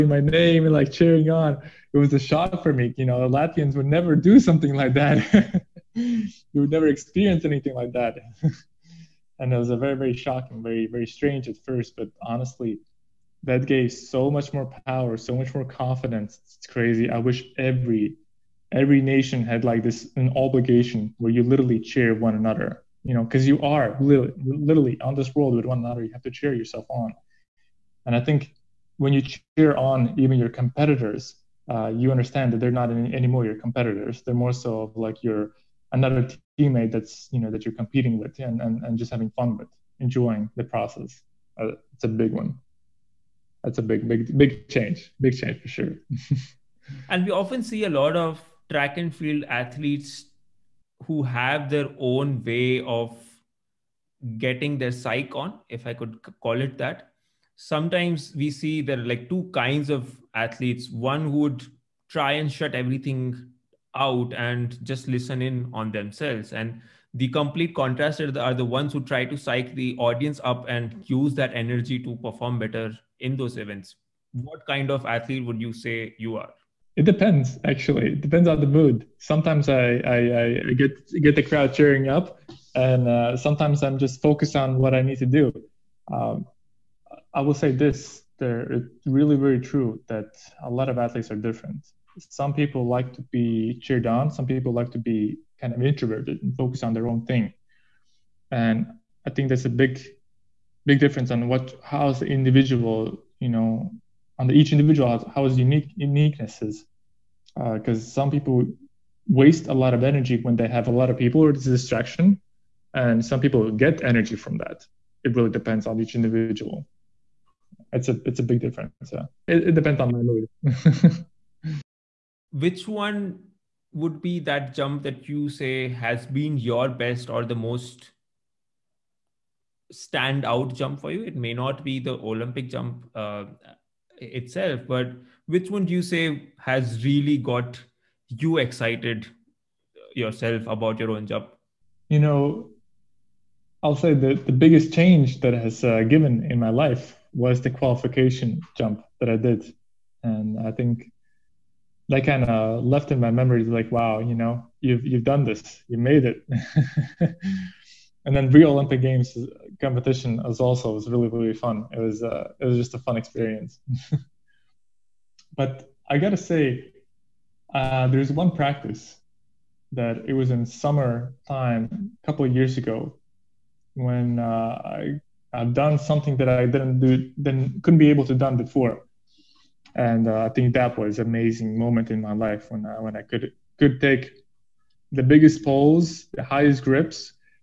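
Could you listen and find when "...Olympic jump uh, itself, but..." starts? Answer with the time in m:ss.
2:12.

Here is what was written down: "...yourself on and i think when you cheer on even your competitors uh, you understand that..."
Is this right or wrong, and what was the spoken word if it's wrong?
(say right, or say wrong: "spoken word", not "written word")
right.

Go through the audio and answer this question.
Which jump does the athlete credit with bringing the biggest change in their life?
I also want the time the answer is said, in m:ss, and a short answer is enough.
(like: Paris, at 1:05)
The qualification jump, at 2:27.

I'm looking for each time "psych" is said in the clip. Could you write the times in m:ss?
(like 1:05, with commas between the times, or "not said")
0:54, 1:09.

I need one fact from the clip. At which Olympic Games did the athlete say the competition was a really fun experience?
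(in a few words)
Rio.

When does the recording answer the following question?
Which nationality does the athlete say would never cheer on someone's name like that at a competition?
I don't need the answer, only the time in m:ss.
0:03.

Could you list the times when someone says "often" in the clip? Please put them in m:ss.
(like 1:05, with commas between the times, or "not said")
0:47.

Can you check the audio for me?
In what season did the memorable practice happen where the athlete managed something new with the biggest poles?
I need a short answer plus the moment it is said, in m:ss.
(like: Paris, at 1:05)
Summer, at 2:50.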